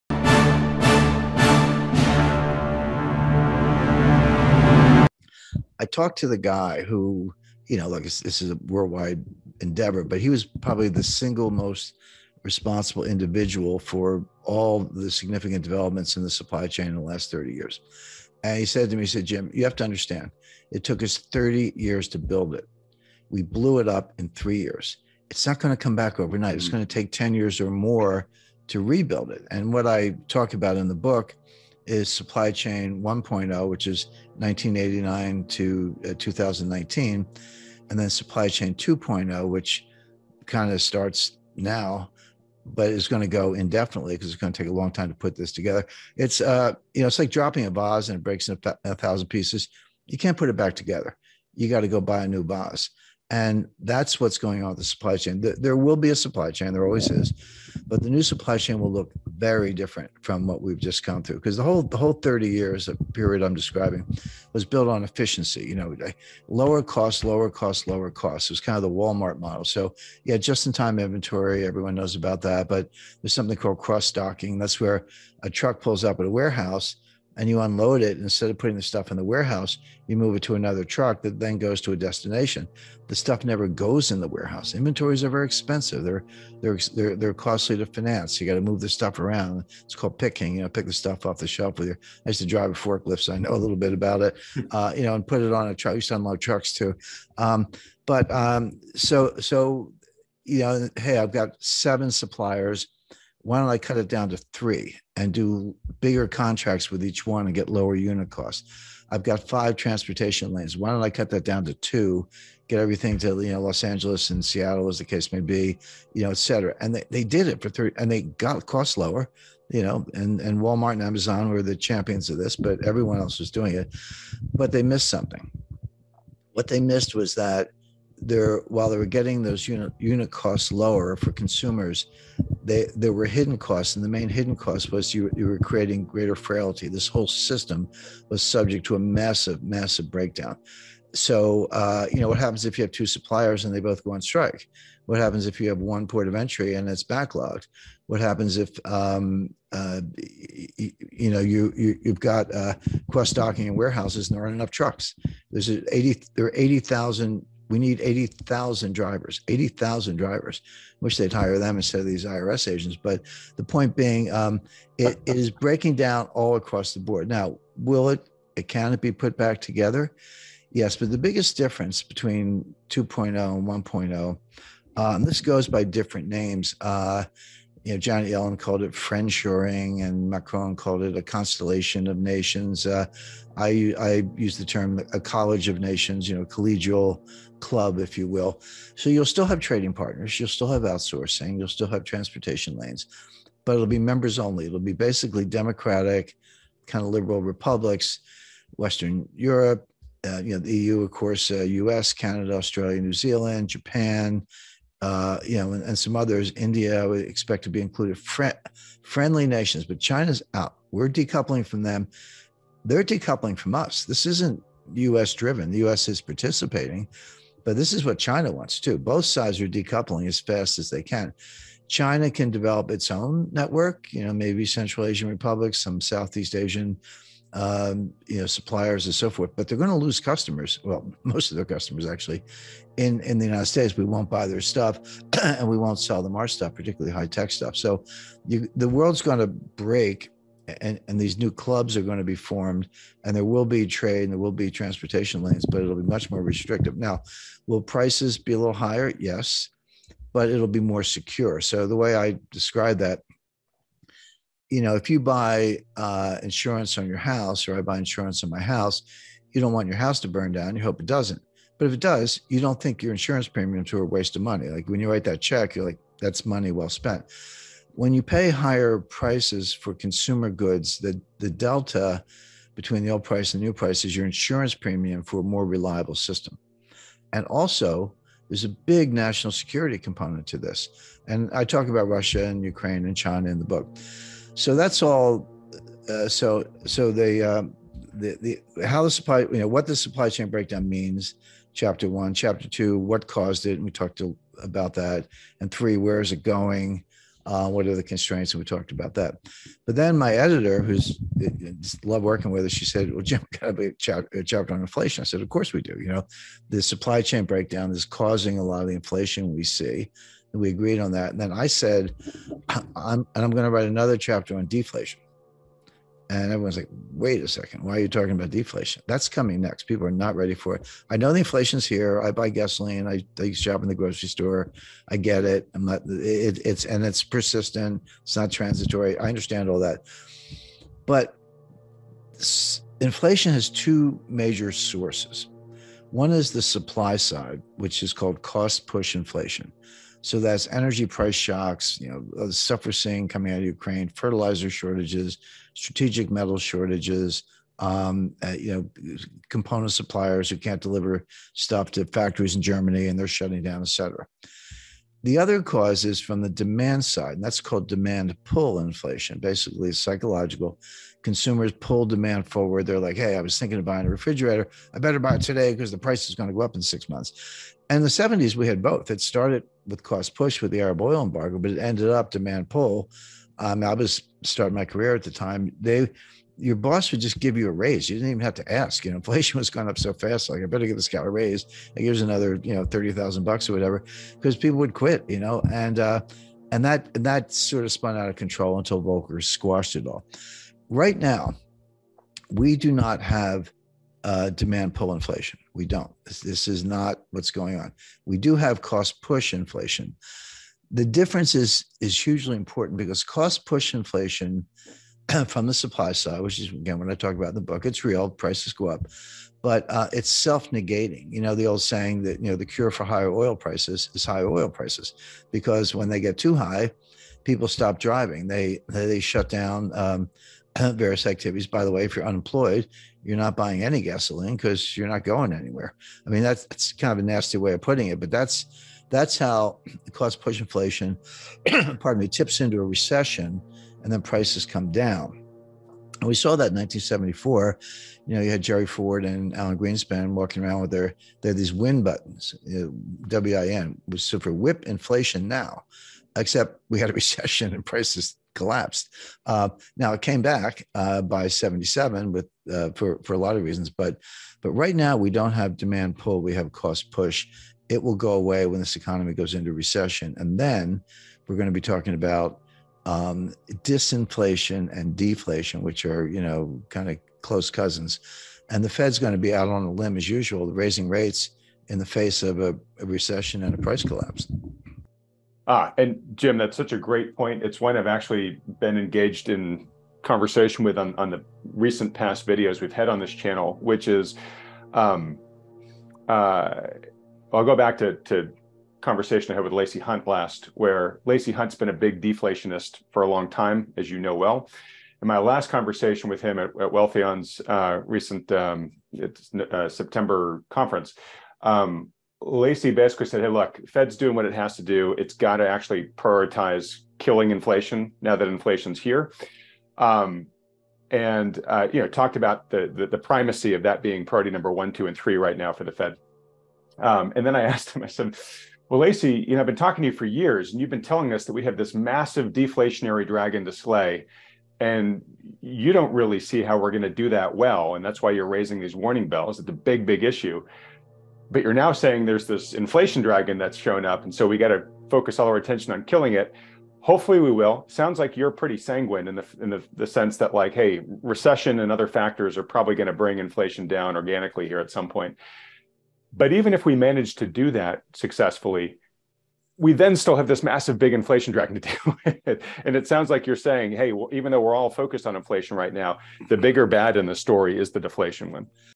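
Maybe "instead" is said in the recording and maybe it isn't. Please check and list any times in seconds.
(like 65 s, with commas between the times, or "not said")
78 s, 161 s.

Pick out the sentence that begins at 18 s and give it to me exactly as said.
And he said to me, he said, Jim, you have to understand, it took us 30 years to build it.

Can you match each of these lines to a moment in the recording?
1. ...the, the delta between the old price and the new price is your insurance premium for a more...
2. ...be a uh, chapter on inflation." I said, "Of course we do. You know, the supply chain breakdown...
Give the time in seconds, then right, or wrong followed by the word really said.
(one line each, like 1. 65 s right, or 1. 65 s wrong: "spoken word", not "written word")
1. 270 s right
2. 303 s right.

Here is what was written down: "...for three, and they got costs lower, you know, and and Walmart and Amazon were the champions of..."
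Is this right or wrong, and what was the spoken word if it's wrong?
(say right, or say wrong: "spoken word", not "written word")
right.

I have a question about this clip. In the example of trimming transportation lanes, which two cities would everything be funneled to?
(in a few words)
Los Angeles and Seattle.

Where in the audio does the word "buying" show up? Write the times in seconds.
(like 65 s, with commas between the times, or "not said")
363 s, 423 s.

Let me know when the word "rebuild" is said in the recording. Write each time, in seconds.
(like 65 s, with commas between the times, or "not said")
28 s.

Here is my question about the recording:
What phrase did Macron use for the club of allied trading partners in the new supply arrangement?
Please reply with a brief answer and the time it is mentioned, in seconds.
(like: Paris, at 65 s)
a constellation of nations, at 181 s.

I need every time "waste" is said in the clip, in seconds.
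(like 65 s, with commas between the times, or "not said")
264 s.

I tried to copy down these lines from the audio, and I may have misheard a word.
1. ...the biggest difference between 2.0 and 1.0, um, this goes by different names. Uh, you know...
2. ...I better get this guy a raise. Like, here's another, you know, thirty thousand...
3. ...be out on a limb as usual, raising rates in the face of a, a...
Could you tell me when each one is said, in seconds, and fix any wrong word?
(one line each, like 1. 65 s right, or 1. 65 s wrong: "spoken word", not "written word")
1. 171 s right
2. 380 s right
3. 469 s right.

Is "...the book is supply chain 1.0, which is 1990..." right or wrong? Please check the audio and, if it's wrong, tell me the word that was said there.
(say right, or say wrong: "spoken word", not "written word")
wrong: "1989", not "1990".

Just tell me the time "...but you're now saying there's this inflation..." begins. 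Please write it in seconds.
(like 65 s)
531 s.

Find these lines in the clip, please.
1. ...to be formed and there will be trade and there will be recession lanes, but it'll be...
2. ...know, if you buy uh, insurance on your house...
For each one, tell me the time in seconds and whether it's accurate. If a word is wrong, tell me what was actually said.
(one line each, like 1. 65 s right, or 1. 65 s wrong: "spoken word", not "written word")
1. 242 s wrong: "transportation", not "recession"
2. 254 s right.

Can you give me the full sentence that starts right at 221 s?
China can develop its own network.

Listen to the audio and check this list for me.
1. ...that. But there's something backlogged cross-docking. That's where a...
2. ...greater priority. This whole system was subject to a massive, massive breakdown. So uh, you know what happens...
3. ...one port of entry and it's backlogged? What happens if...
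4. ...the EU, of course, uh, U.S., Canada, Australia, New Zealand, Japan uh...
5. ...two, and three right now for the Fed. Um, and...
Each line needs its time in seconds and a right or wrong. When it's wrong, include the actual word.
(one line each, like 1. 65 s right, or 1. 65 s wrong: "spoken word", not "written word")
1. 72 s wrong: "called", not "backlogged"
2. 136 s wrong: "frailty", not "priority"
3. 145 s right
4. 200 s right
5. 514 s right.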